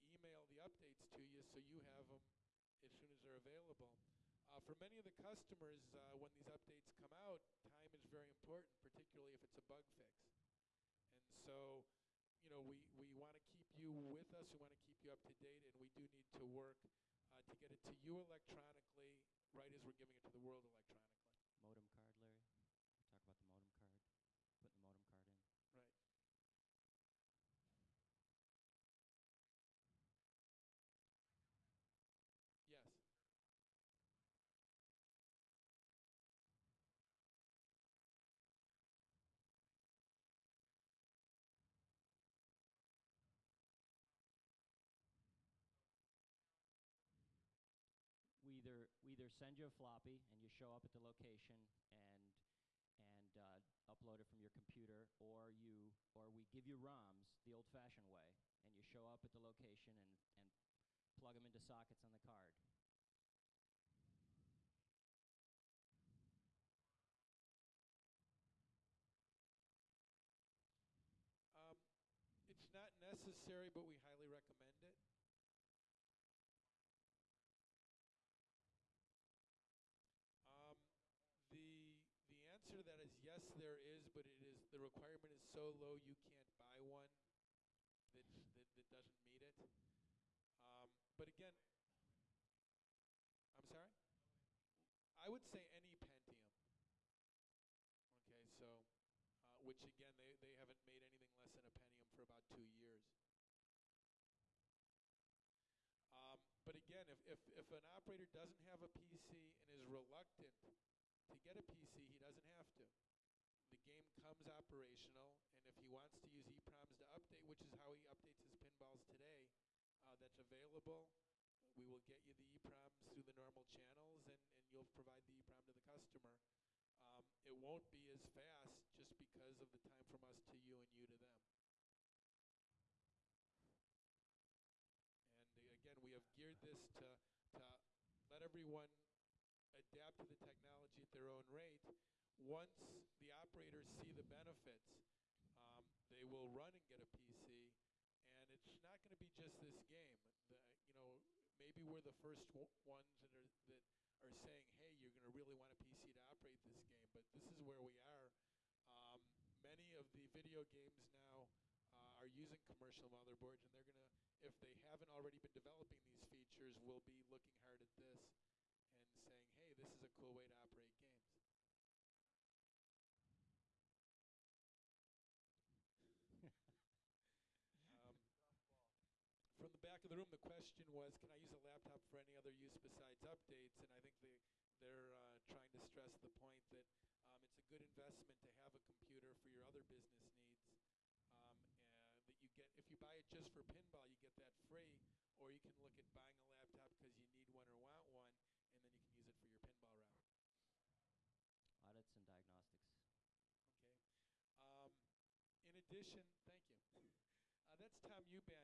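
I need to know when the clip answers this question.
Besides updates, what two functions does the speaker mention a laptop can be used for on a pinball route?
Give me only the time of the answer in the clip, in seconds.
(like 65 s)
201 s.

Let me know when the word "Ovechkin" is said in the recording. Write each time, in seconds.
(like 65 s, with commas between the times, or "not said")
not said.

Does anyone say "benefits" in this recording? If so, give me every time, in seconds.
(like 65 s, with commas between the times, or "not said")
144 s.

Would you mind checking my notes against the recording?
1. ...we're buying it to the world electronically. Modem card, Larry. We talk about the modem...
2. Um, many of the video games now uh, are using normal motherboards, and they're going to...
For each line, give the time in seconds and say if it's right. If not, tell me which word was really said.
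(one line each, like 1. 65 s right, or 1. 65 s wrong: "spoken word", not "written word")
1. 19 s wrong: "giving", not "buying"
2. 158 s wrong: "commercial", not "normal".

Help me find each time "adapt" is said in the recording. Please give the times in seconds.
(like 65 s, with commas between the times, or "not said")
139 s.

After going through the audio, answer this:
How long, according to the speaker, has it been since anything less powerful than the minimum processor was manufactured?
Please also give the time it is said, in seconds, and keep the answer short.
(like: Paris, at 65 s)
About two years, at 102 s.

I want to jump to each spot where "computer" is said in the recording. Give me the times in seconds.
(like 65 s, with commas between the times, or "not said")
54 s, 188 s.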